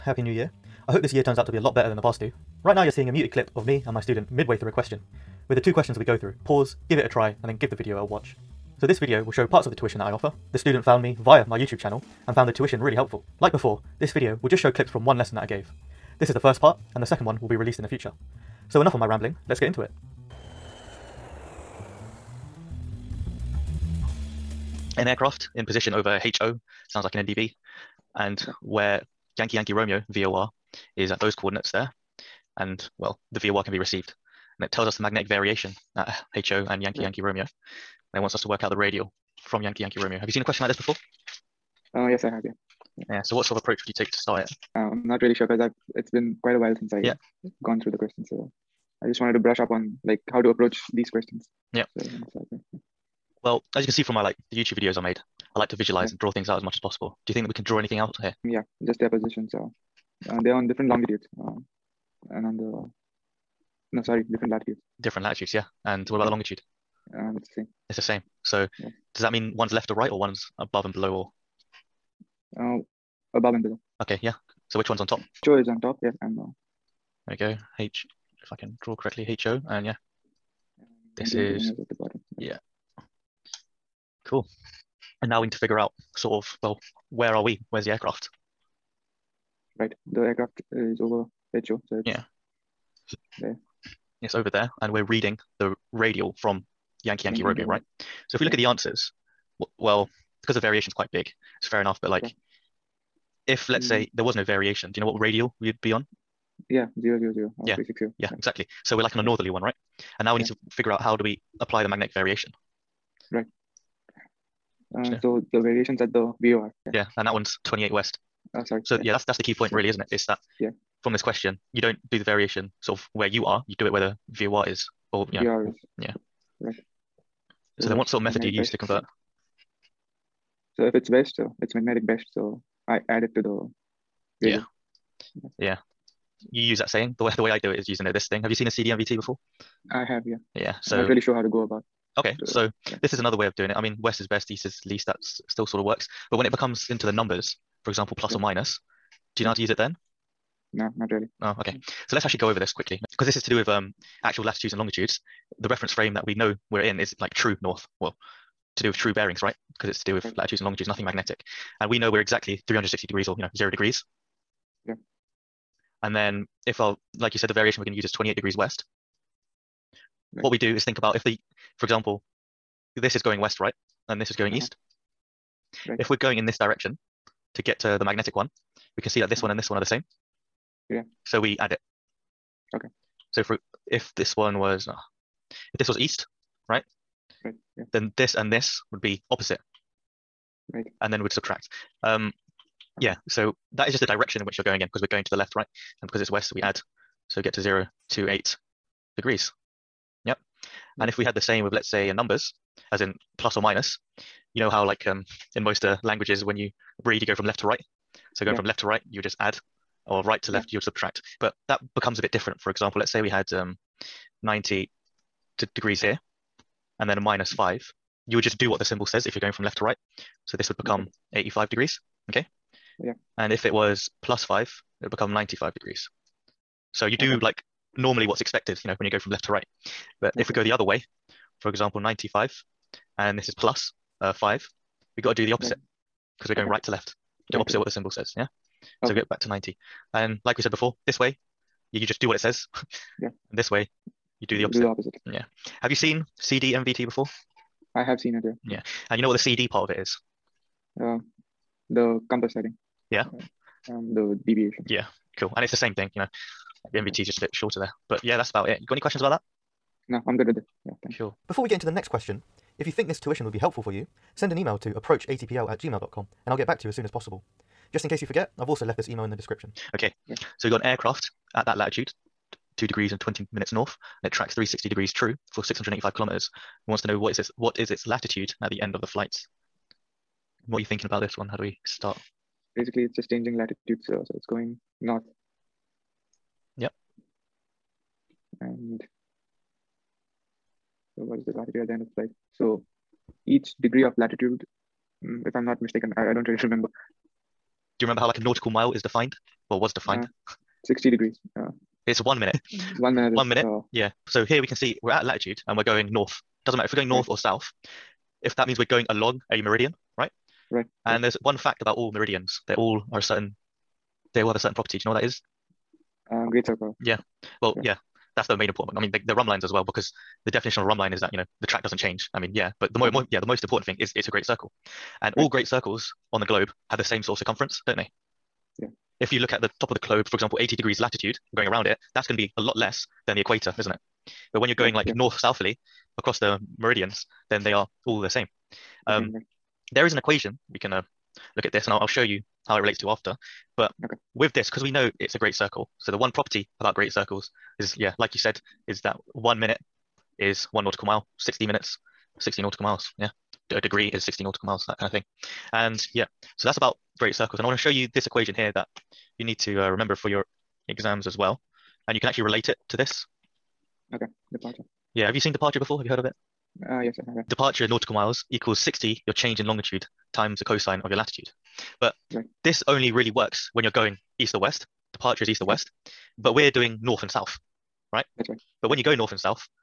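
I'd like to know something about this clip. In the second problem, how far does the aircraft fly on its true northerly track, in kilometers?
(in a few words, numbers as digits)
685.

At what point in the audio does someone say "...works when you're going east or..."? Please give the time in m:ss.
6:13.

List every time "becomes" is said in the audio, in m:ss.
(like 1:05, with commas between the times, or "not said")
2:26, 3:31, 3:40, 3:45.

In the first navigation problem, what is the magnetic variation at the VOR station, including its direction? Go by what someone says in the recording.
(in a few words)
28 West.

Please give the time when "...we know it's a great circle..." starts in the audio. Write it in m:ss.
5:44.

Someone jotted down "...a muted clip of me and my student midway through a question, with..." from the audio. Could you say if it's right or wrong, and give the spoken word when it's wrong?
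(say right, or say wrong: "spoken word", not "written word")
right.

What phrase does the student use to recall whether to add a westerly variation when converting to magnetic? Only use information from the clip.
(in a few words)
west is best.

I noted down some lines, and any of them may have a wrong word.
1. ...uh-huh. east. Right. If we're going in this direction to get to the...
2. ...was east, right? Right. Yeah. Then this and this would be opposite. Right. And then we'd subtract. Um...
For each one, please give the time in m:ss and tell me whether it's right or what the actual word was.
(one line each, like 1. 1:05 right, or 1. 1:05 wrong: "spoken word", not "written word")
1. 2:54 right
2. 3:05 right.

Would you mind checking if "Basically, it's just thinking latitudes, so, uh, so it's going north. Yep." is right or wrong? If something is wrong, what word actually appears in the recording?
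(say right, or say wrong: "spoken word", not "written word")
wrong: "changing", not "thinking".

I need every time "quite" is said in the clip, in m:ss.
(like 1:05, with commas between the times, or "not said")
0:46, 1:40.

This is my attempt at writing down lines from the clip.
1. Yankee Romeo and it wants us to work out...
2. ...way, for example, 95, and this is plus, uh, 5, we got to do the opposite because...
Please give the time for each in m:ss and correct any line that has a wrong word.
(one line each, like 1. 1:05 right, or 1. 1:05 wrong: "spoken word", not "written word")
1. 0:37 right
2. 3:50 right.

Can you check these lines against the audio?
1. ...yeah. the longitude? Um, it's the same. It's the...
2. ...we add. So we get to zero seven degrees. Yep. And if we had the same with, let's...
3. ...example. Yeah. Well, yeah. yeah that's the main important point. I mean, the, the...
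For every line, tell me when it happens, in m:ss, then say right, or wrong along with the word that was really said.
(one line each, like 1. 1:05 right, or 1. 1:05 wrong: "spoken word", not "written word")
1. 1:06 right
2. 3:16 wrong: "eight", not "seven"
3. 5:16 wrong: "circle", not "example".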